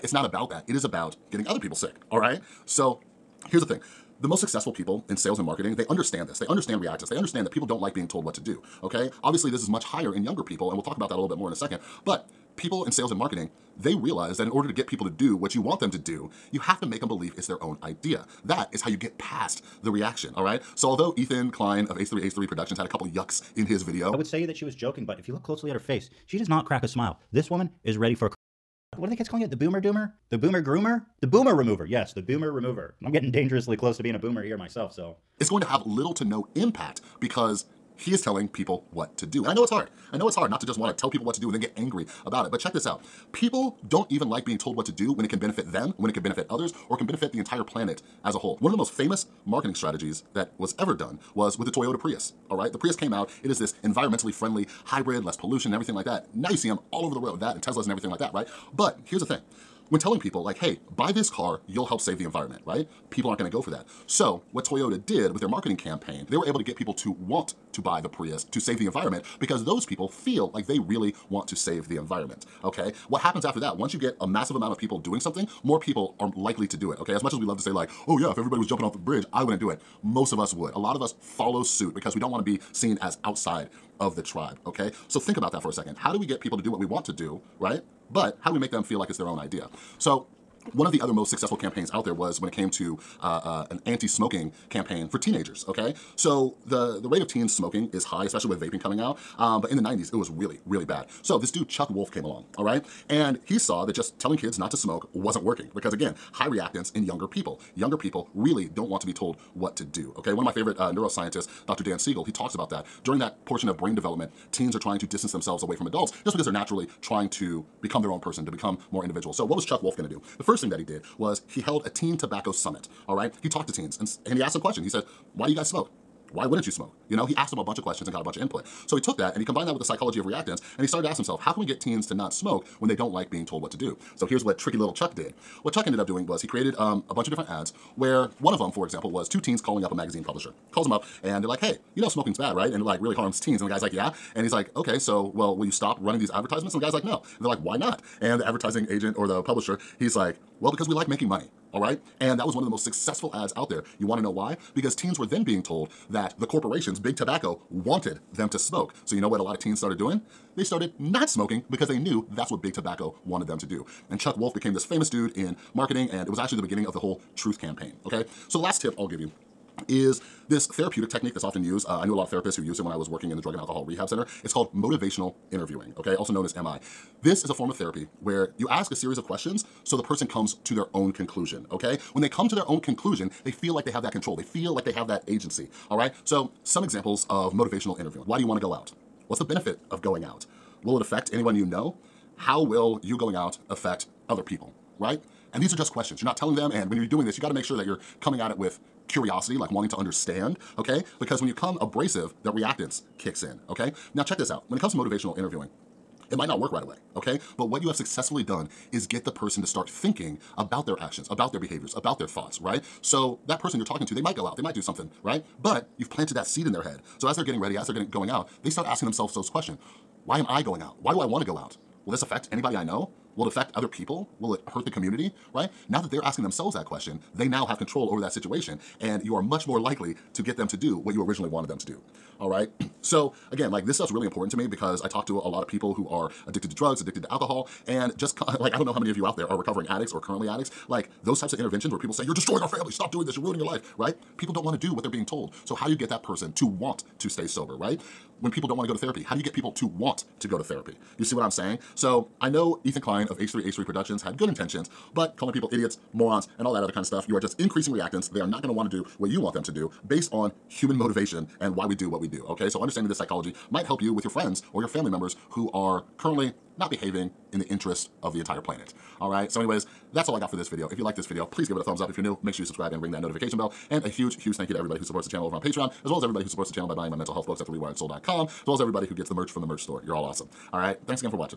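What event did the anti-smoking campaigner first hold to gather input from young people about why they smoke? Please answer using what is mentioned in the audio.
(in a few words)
teen tobacco summit.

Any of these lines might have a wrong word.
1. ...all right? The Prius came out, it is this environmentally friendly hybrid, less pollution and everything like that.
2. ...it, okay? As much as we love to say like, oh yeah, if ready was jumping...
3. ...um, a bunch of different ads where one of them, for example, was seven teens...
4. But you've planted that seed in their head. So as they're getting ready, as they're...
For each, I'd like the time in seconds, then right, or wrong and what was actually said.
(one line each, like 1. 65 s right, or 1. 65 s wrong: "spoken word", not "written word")
1. 52 s right
2. 76 s wrong: "everybody", not "ready"
3. 136 s wrong: "two", not "seven"
4. 215 s right.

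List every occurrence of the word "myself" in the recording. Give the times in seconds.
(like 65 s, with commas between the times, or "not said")
34 s.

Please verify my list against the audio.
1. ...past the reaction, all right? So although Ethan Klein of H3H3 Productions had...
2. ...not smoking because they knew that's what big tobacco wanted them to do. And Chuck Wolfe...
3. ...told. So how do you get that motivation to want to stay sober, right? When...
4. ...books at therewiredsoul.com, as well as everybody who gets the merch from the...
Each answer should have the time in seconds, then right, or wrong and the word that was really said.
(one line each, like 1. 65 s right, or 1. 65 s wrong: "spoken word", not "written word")
1. 19 s right
2. 160 s right
3. 245 s wrong: "person", not "motivation"
4. 277 s right.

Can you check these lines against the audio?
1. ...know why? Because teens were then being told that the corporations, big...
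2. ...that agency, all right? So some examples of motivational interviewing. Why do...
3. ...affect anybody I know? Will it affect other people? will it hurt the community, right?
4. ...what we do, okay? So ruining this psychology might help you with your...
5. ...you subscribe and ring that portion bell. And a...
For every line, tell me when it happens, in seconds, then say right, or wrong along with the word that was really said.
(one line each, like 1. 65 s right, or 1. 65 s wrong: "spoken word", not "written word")
1. 154 s right
2. 185 s right
3. 222 s right
4. 262 s wrong: "understanding", not "ruining"
5. 272 s wrong: "notification", not "portion".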